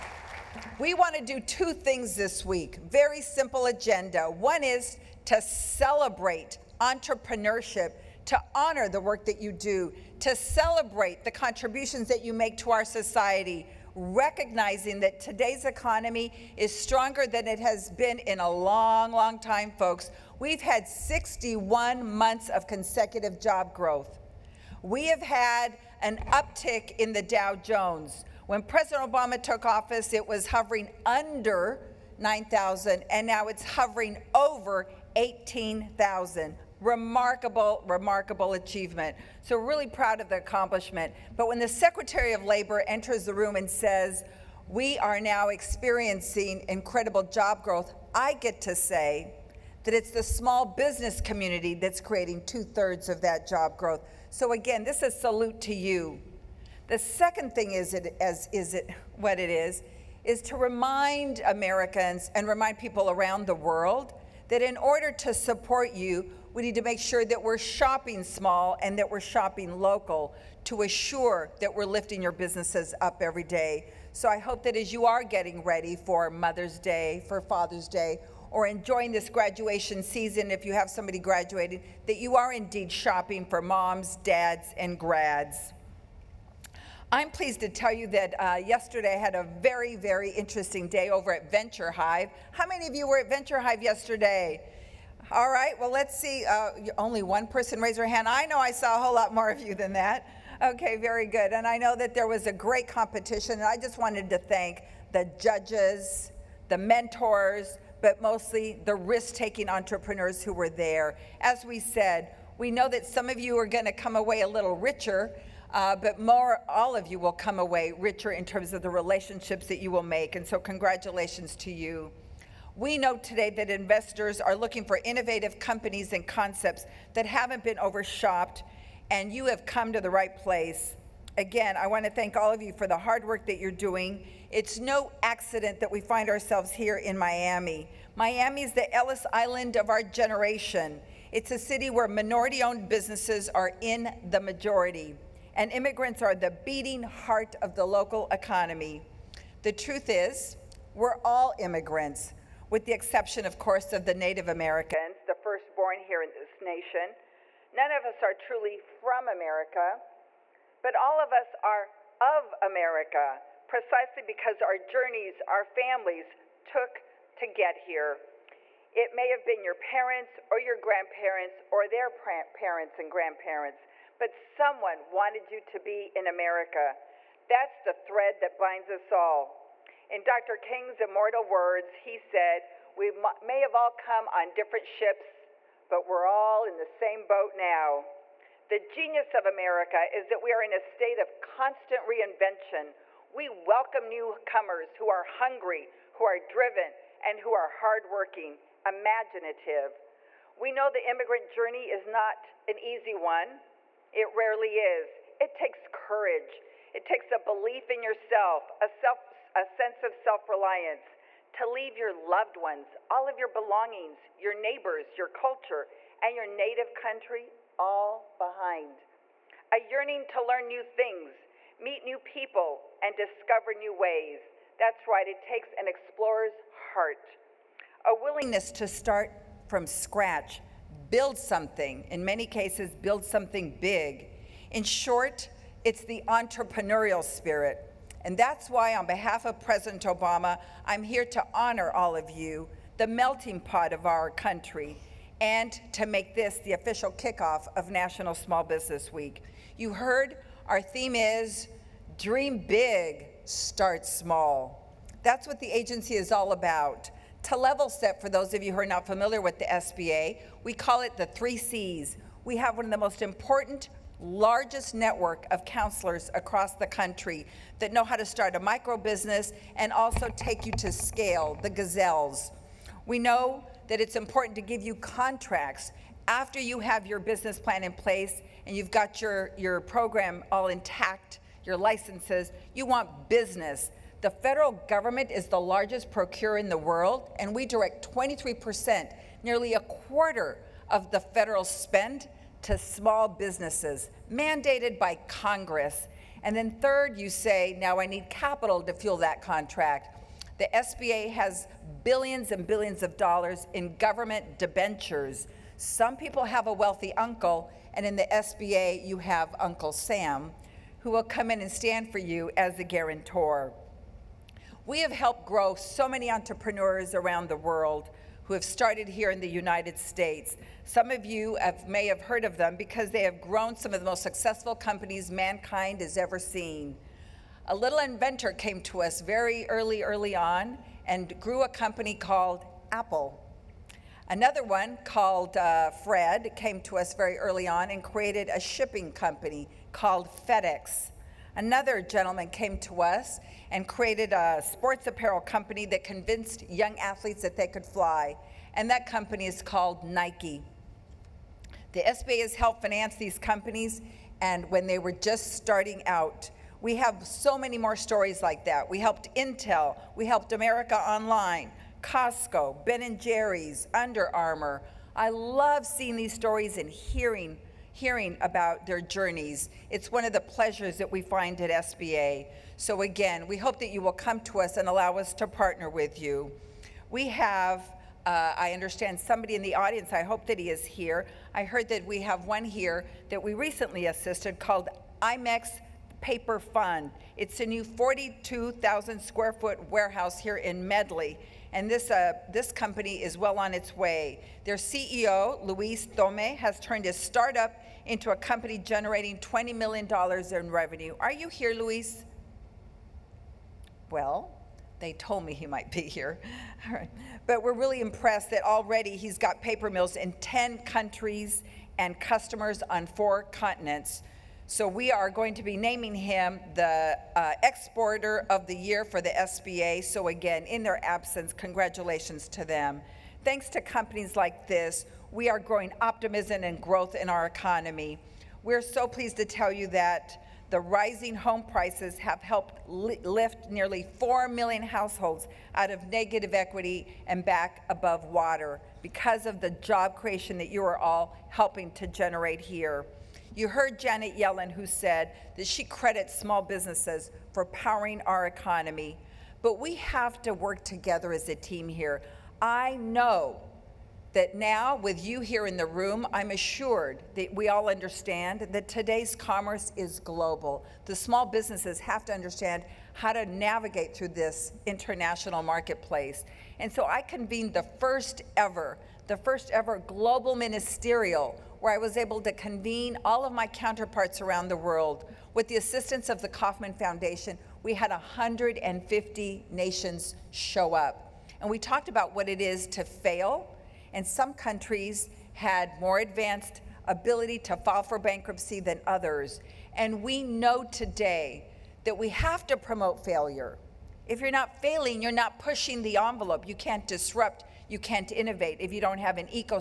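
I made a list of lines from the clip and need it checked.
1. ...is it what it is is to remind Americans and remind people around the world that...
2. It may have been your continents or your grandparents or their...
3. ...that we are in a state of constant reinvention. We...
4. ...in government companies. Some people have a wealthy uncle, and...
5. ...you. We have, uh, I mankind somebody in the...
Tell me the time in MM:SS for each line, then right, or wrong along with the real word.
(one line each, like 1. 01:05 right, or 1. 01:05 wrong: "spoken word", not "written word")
1. 00:58 right
2. 02:48 wrong: "parents", not "continents"
3. 03:10 right
4. 05:03 wrong: "debentures", not "companies"
5. 06:16 wrong: "understand", not "mankind".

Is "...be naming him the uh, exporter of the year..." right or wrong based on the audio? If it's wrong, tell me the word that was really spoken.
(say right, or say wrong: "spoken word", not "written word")
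right.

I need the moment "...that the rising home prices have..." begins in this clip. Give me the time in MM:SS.
07:09.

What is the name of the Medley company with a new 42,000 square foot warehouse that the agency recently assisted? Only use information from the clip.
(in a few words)
IMEX Paper Fund.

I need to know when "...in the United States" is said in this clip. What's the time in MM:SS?
05:19.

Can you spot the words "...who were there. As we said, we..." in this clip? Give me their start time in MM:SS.
01:50.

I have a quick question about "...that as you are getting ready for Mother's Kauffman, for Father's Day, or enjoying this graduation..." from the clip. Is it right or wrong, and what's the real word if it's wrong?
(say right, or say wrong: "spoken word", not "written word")
wrong: "Day", not "Kauffman".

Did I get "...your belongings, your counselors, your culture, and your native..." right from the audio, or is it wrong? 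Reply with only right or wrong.
wrong.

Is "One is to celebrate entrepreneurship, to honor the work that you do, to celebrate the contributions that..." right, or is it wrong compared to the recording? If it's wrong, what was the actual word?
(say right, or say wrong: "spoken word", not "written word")
right.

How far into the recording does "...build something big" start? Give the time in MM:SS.
03:53.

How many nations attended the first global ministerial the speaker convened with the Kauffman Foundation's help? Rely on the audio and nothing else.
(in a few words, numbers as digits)
150.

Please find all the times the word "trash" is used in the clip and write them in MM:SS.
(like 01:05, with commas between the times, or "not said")
not said.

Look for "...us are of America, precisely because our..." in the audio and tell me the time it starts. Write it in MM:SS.
02:41.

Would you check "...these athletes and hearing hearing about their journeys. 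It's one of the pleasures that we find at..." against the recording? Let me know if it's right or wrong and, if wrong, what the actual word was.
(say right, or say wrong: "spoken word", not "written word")
wrong: "stories", not "athletes".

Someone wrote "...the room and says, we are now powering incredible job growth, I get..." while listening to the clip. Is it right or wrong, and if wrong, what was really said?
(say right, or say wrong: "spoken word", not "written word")
wrong: "experiencing", not "powering".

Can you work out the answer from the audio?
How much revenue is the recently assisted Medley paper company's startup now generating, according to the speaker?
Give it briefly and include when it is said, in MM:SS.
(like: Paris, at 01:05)
$20 million, at 06:39.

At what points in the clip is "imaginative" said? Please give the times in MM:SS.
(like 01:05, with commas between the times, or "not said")
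03:18.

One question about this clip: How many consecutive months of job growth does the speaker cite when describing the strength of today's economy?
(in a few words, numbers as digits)
61.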